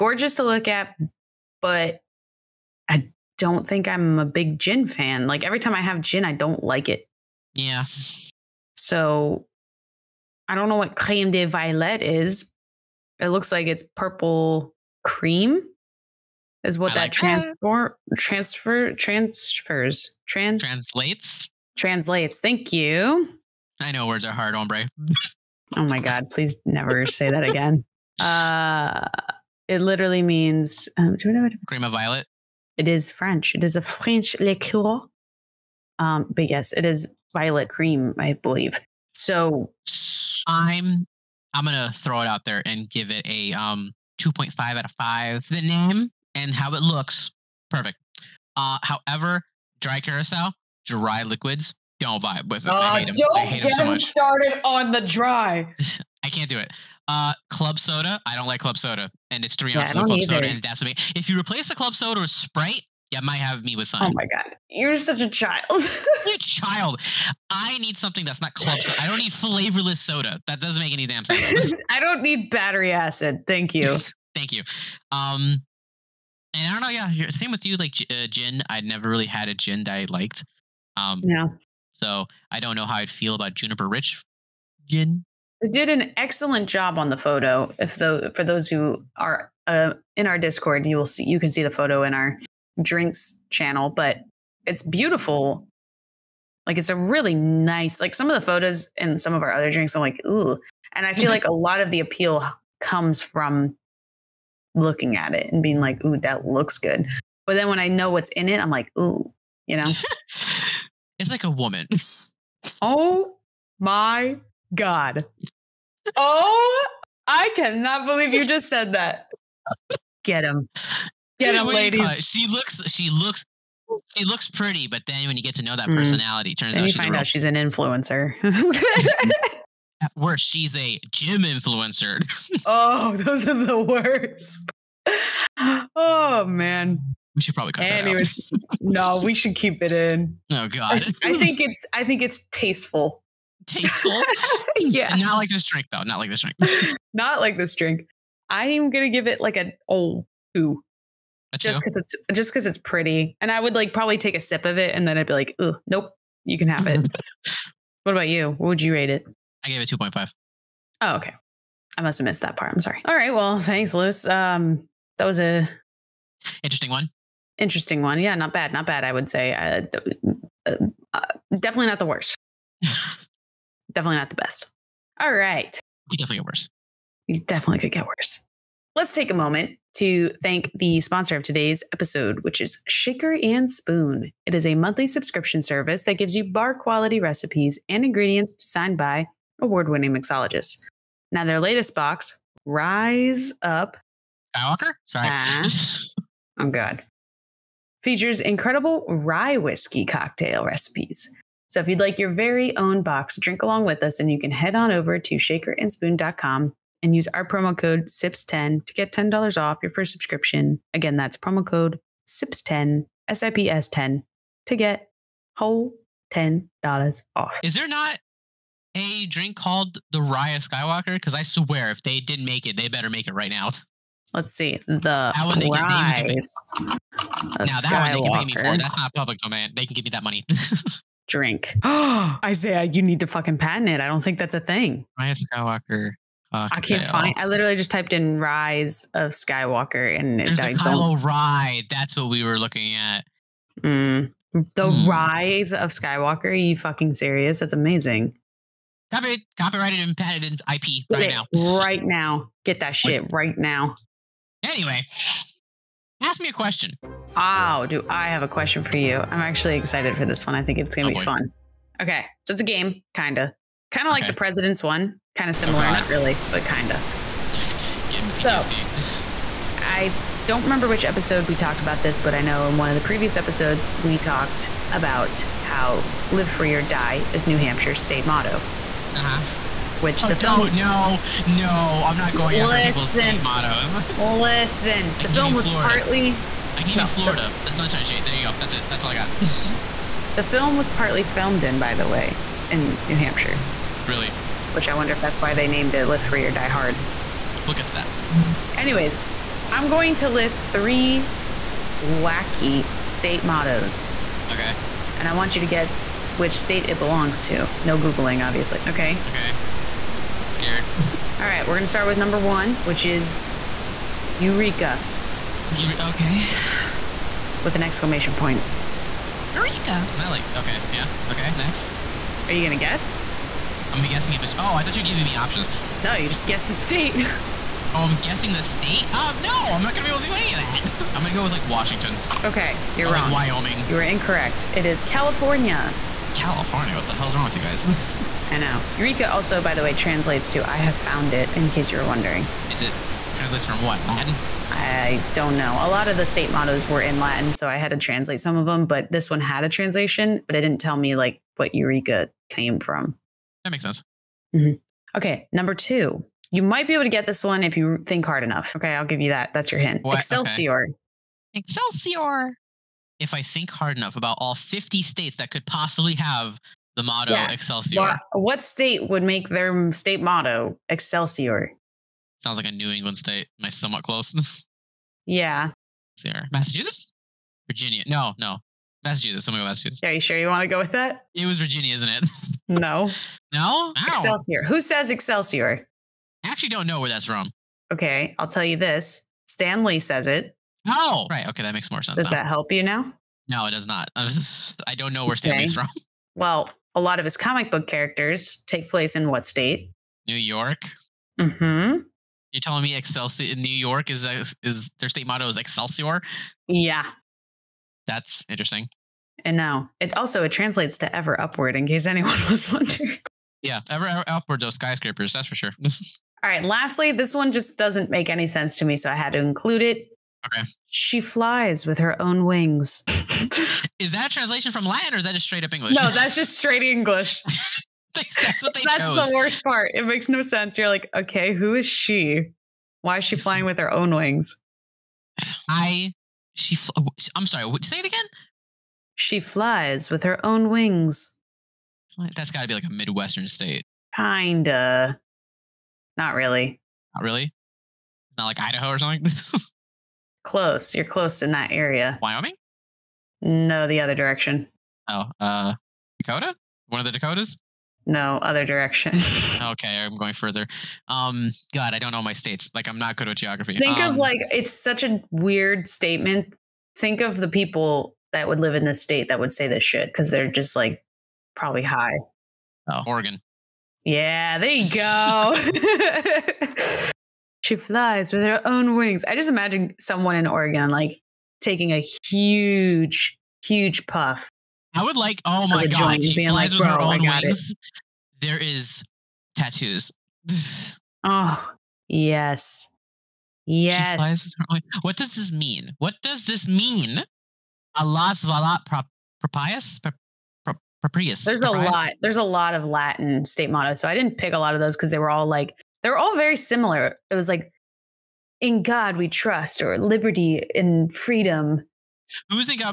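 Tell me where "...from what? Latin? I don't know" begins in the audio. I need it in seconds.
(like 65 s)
343 s.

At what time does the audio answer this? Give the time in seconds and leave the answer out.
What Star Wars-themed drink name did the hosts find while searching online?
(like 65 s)
240 s.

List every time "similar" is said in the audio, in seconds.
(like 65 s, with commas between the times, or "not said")
265 s, 506 s.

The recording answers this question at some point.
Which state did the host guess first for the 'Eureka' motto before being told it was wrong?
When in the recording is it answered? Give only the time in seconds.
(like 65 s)
331 s.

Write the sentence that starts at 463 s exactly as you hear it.
Think um, of like it's such a weird statement.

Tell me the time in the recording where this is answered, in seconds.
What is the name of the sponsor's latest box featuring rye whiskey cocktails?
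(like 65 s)
192 s.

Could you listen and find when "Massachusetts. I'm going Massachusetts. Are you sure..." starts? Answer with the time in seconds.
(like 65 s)
379 s.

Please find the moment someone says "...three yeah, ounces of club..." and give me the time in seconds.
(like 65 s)
59 s.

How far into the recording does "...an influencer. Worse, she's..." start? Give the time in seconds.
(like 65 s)
127 s.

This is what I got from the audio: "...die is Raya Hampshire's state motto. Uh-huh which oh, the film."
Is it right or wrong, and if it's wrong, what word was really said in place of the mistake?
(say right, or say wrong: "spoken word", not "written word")
wrong: "New", not "Raya".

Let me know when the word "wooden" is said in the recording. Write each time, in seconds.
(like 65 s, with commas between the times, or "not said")
not said.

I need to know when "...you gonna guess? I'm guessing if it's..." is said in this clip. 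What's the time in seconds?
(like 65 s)
322 s.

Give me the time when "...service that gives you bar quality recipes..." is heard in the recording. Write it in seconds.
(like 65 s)
185 s.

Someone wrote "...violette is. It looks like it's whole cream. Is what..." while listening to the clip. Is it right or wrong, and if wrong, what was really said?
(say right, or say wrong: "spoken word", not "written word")
wrong: "purple", not "whole".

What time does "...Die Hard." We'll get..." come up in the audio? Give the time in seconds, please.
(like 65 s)
296 s.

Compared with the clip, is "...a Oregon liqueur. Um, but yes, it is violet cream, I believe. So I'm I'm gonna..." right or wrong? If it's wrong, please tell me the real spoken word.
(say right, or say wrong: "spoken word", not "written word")
wrong: "French", not "Oregon".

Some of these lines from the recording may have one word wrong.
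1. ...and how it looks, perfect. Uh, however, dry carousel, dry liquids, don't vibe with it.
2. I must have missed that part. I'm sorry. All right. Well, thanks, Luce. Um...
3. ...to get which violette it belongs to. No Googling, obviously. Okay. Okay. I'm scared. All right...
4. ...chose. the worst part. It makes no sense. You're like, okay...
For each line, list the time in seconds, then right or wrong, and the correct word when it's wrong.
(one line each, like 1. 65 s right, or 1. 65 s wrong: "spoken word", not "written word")
1. 46 s right
2. 161 s right
3. 305 s wrong: "state", not "violette"
4. 429 s right.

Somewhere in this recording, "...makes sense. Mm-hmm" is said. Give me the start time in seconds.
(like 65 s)
353 s.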